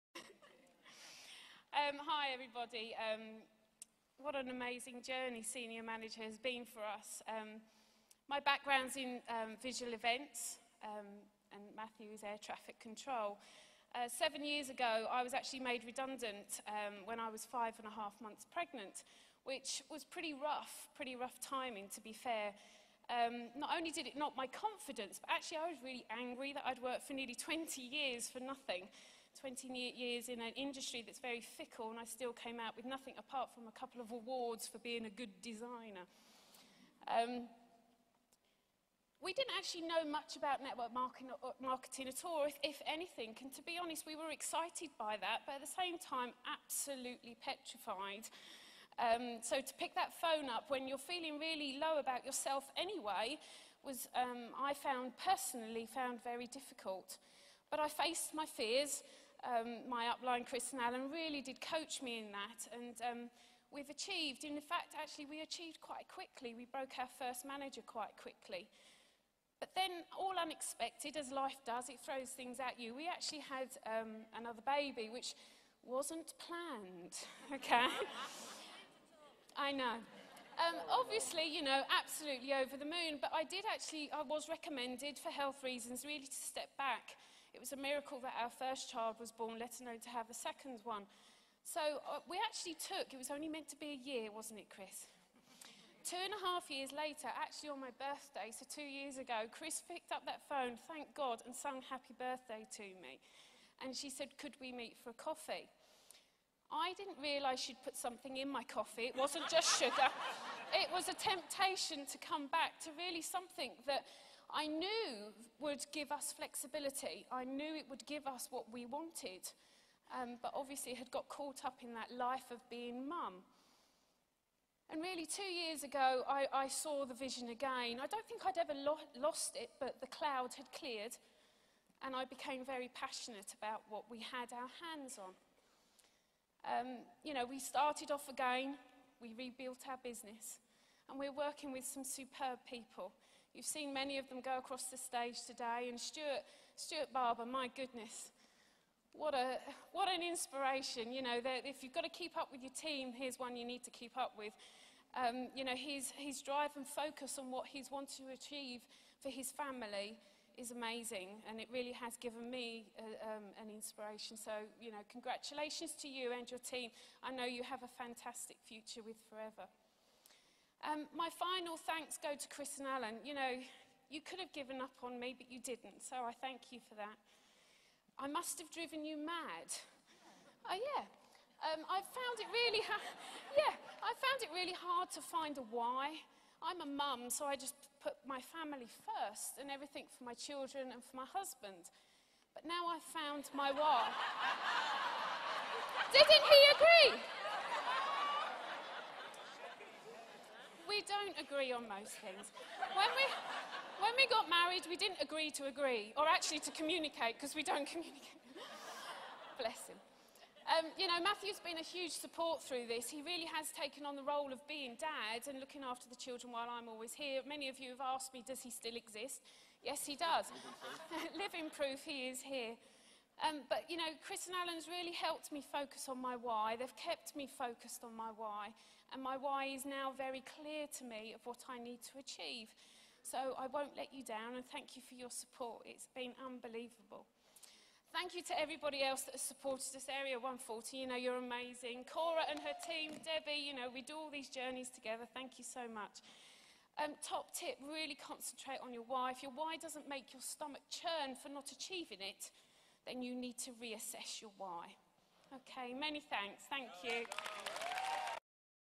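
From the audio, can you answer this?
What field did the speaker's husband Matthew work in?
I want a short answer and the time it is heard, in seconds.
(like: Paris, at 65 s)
Air traffic control, at 12 s.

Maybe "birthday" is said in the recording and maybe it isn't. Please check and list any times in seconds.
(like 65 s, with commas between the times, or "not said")
98 s, 102 s.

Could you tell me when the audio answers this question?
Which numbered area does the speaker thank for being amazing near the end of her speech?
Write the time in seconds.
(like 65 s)
240 s.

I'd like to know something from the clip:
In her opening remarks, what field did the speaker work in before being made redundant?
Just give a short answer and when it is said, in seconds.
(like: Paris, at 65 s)
Visual events, at 9 s.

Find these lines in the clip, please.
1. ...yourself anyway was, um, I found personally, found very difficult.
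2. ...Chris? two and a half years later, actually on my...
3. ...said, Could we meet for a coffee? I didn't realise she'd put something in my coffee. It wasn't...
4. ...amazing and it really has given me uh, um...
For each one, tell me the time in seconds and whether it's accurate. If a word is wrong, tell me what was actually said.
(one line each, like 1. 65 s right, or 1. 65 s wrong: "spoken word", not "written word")
1. 52 s right
2. 94 s right
3. 104 s right
4. 160 s right.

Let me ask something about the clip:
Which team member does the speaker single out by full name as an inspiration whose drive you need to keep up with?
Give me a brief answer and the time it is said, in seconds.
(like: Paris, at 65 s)
Stuart Barber, at 146 s.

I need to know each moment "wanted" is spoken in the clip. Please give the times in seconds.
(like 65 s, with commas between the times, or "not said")
118 s, 157 s.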